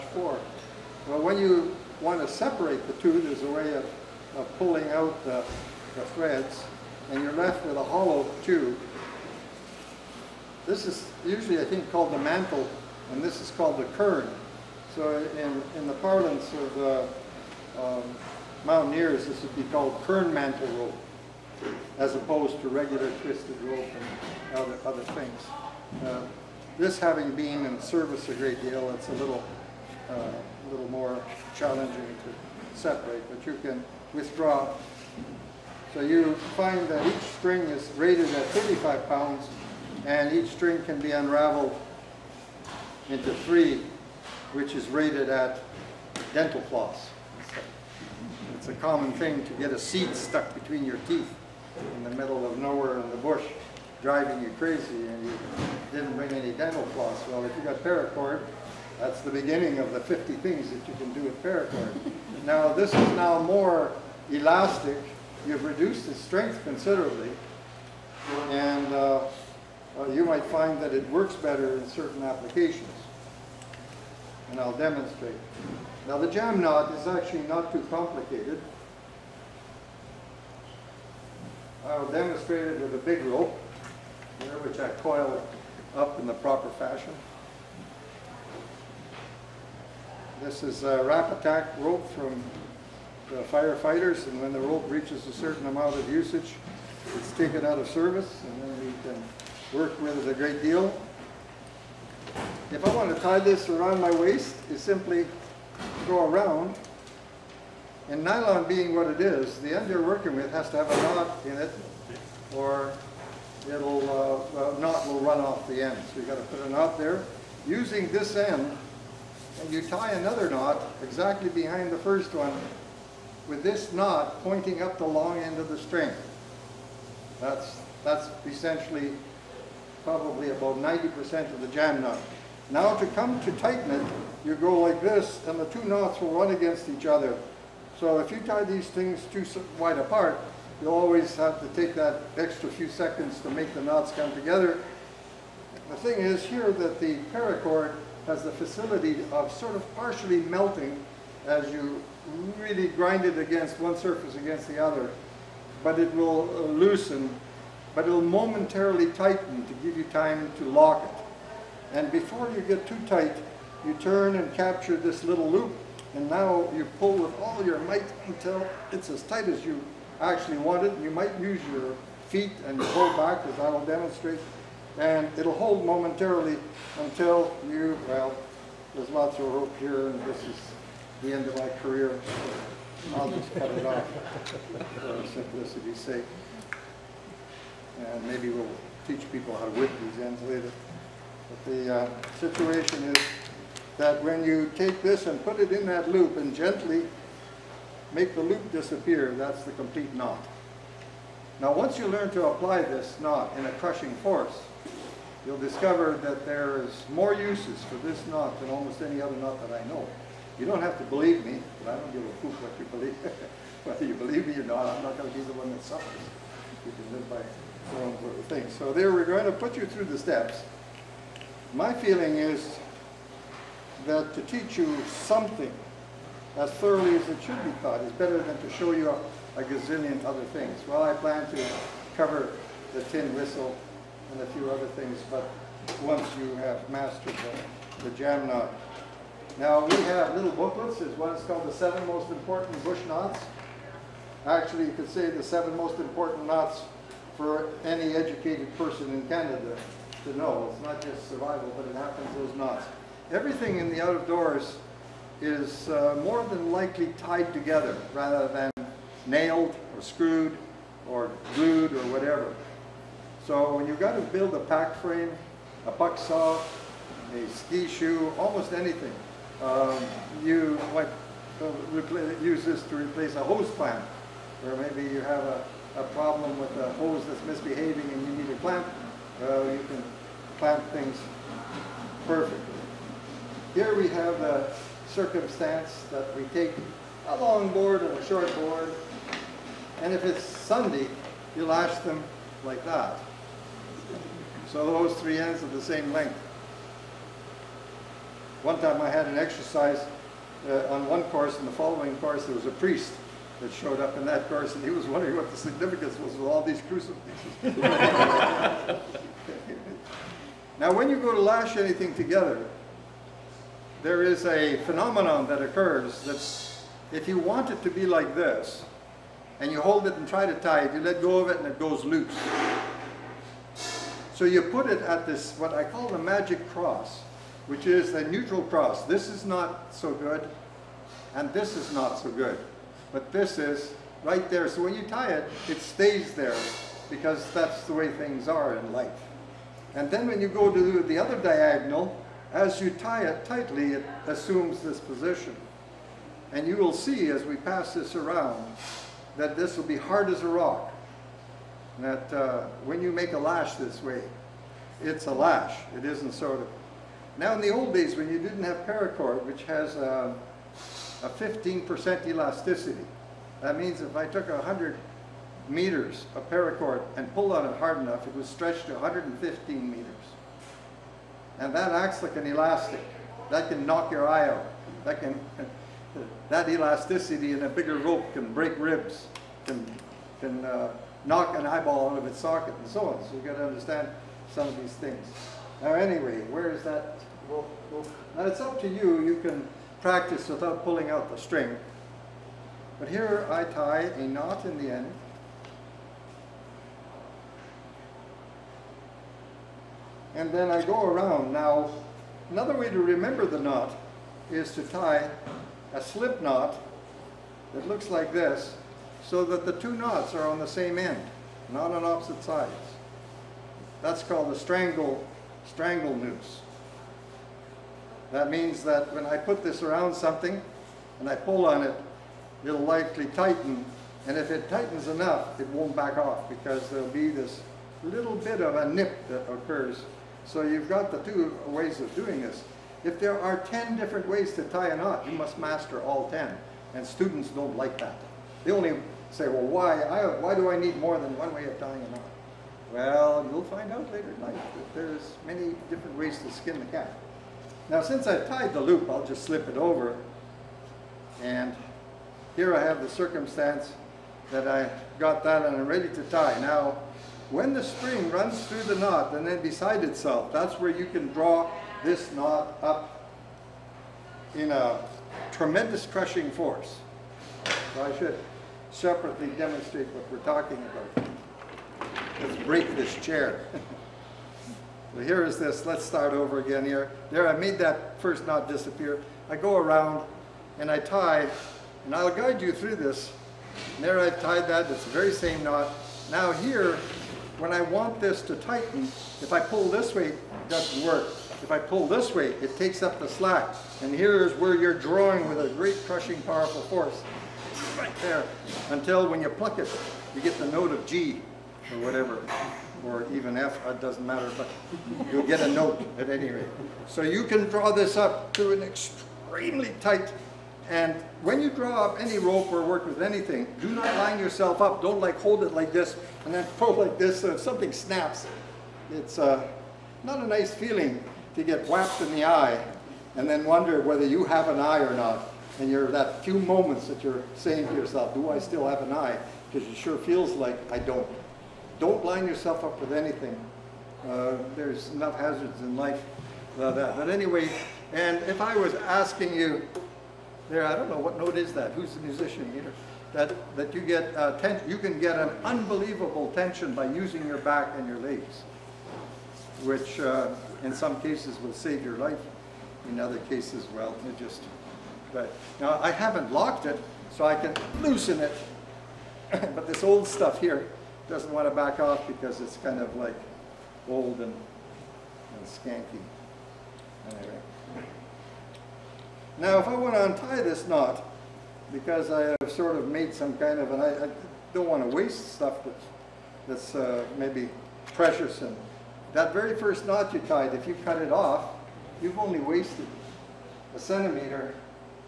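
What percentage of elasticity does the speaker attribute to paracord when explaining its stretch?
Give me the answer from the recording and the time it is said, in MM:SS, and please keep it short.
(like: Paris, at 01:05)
15%, at 06:01.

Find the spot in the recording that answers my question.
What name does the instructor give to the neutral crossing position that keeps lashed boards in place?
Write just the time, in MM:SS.
05:26.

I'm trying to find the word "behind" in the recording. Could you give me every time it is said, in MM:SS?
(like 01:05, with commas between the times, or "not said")
02:01.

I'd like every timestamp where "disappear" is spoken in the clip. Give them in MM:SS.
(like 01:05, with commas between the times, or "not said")
03:18, 07:58.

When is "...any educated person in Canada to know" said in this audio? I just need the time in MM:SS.
04:07.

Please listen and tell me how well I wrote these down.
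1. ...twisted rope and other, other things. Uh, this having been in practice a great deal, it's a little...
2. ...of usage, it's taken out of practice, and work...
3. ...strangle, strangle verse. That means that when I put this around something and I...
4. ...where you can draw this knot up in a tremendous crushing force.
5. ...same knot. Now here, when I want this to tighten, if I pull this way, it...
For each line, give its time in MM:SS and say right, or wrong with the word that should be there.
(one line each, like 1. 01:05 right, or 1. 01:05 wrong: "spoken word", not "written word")
1. 00:23 wrong: "service", not "practice"
2. 01:35 wrong: "service", not "practice"
3. 06:54 wrong: "noose", not "verse"
4. 07:40 right
5. 08:05 right.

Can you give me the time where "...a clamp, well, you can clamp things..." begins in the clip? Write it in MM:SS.
04:38.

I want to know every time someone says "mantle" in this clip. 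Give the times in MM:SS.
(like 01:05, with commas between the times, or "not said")
00:12, 00:20.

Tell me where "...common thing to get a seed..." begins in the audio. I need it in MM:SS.
00:48.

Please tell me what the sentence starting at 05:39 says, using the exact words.
And then when you go to the other diagonal, as you tie it tightly, it assumes this position.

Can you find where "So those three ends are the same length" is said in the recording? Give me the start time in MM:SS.
04:54.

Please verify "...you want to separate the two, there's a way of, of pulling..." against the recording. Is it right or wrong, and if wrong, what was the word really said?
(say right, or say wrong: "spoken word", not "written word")
right.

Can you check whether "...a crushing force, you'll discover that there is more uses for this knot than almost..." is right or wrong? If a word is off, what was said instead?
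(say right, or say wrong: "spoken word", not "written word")
right.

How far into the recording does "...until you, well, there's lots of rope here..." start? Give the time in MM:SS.
02:56.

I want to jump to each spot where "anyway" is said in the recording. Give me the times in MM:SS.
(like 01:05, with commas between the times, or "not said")
06:25, 08:57, 09:27.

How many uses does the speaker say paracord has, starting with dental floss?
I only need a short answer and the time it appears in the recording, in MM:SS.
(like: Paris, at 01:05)
50, at 00:59.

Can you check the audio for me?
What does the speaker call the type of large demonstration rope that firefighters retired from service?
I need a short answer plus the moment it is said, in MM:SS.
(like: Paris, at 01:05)
Rapattack rope, at 01:30.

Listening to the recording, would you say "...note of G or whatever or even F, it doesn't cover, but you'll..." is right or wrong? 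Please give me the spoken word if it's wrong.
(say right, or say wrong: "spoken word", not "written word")
wrong: "matter", not "cover".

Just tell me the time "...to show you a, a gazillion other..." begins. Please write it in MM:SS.
03:48.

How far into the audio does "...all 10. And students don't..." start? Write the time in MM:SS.
07:16.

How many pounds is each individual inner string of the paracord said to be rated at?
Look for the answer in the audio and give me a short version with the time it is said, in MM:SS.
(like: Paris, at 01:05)
35 pounds, at 00:38.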